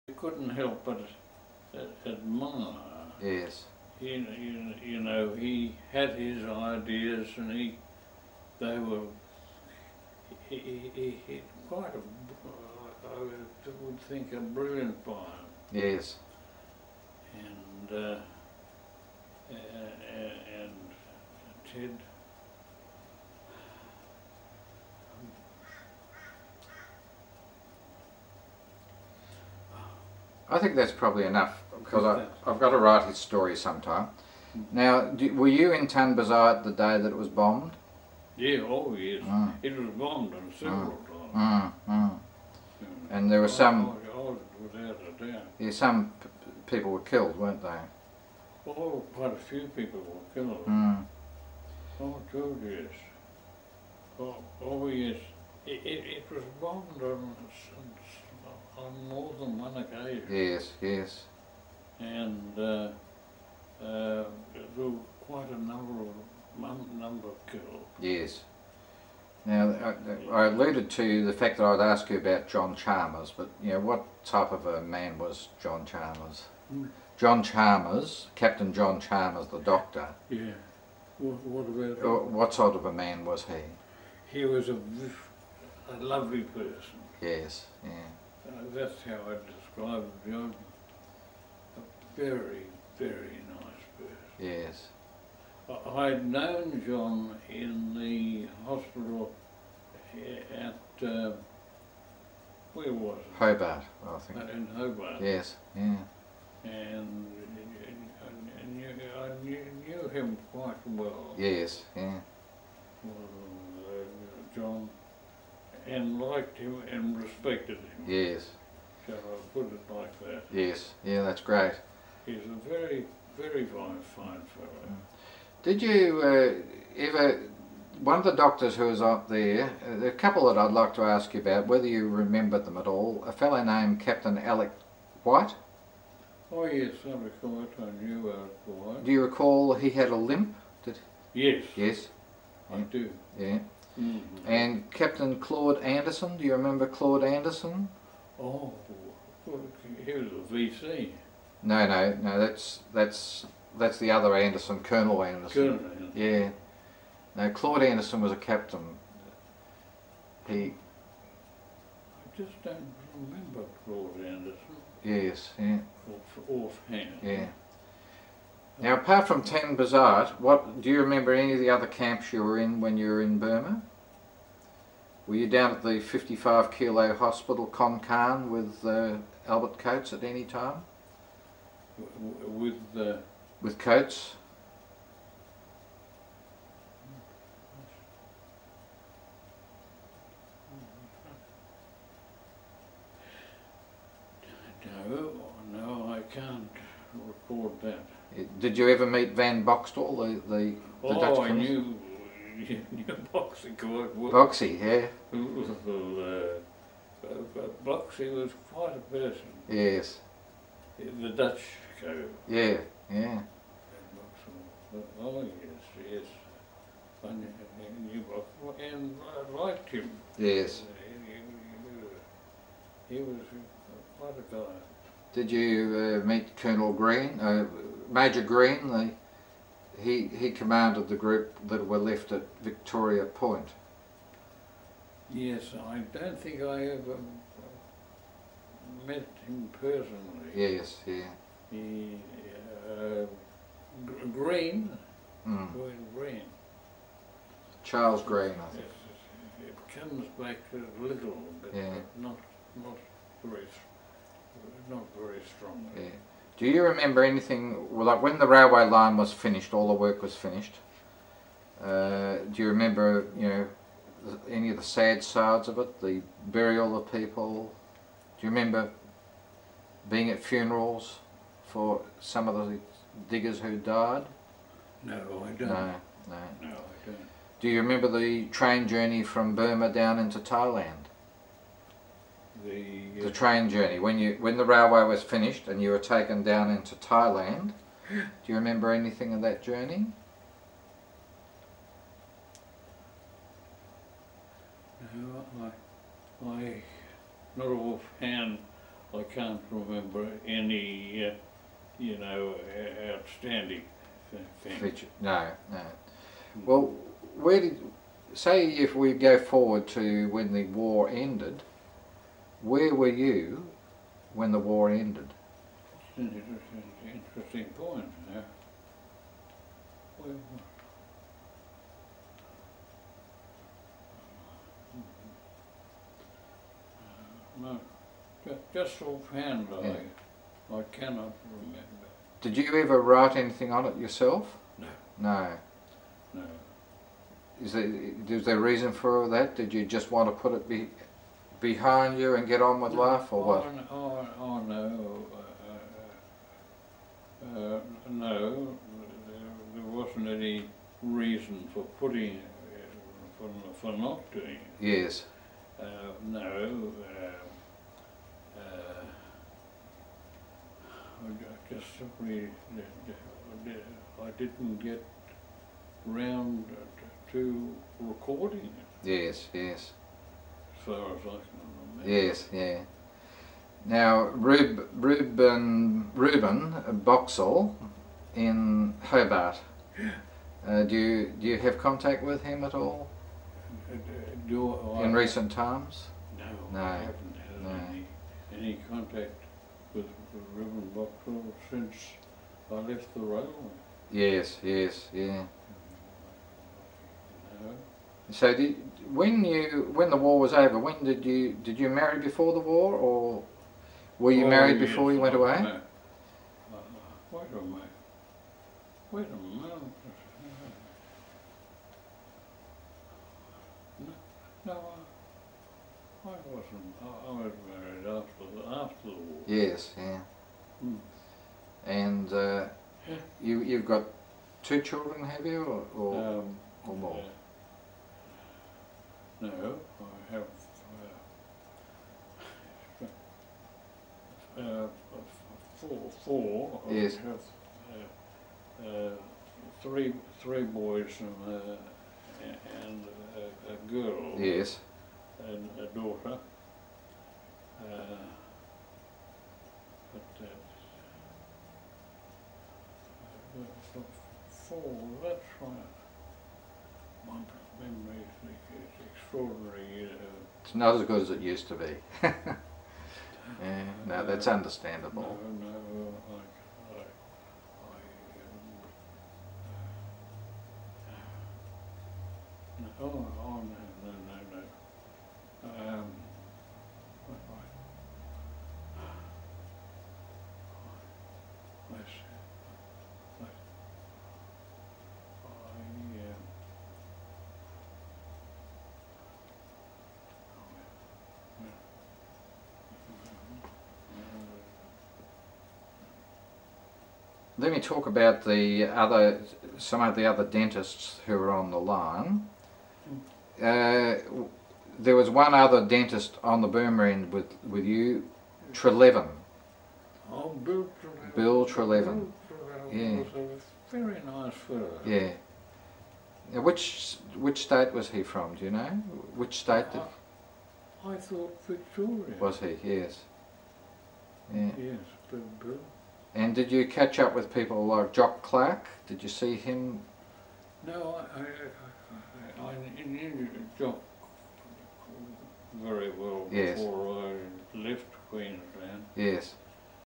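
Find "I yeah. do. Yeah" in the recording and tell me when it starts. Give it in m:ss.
2:22.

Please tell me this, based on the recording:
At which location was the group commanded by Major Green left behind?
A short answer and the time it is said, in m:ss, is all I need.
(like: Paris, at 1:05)
Victoria Point, at 3:52.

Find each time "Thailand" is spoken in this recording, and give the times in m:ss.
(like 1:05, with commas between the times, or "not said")
4:40, 4:46.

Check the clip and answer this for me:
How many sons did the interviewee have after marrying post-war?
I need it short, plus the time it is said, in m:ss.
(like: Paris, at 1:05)
3, at 7:20.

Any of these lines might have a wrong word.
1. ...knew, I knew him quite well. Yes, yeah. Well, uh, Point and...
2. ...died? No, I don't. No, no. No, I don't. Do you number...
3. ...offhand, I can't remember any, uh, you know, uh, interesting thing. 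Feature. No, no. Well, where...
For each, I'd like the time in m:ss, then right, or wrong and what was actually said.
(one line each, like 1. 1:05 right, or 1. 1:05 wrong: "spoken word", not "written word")
1. 1:49 wrong: "John", not "Point"
2. 4:33 wrong: "remember", not "number"
3. 4:57 wrong: "outstanding", not "interesting".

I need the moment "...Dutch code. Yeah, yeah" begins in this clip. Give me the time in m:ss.
3:31.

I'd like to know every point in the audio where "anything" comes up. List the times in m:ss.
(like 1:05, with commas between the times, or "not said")
4:17, 4:48, 5:33.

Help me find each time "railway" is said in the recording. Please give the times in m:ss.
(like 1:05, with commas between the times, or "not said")
4:18, 4:44, 6:33.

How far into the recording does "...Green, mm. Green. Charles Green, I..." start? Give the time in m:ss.
4:04.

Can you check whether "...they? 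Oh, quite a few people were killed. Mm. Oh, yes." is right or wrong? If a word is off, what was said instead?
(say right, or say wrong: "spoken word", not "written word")
right.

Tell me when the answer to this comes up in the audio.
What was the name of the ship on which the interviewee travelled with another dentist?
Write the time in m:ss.
8:26.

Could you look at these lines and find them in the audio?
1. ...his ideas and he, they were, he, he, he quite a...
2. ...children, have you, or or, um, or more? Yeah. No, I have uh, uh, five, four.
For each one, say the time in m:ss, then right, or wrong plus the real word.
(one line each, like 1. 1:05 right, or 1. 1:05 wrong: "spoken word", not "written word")
1. 0:06 right
2. 7:04 wrong: "four", not "five".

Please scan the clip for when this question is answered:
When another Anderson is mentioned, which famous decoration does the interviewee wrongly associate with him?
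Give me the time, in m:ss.
2:30.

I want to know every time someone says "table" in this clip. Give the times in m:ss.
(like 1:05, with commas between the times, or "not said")
not said.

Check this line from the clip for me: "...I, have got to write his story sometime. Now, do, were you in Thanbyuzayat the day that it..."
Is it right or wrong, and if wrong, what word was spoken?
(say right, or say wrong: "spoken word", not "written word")
right.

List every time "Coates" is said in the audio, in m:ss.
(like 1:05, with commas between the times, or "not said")
2:59, 3:03.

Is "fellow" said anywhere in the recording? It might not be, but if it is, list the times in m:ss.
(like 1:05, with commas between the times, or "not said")
2:04, 2:13, 8:34.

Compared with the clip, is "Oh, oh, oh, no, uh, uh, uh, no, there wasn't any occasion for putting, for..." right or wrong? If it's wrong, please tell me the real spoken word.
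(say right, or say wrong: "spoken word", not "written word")
wrong: "reason", not "occasion".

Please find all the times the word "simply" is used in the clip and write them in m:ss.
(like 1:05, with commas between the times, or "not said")
6:01.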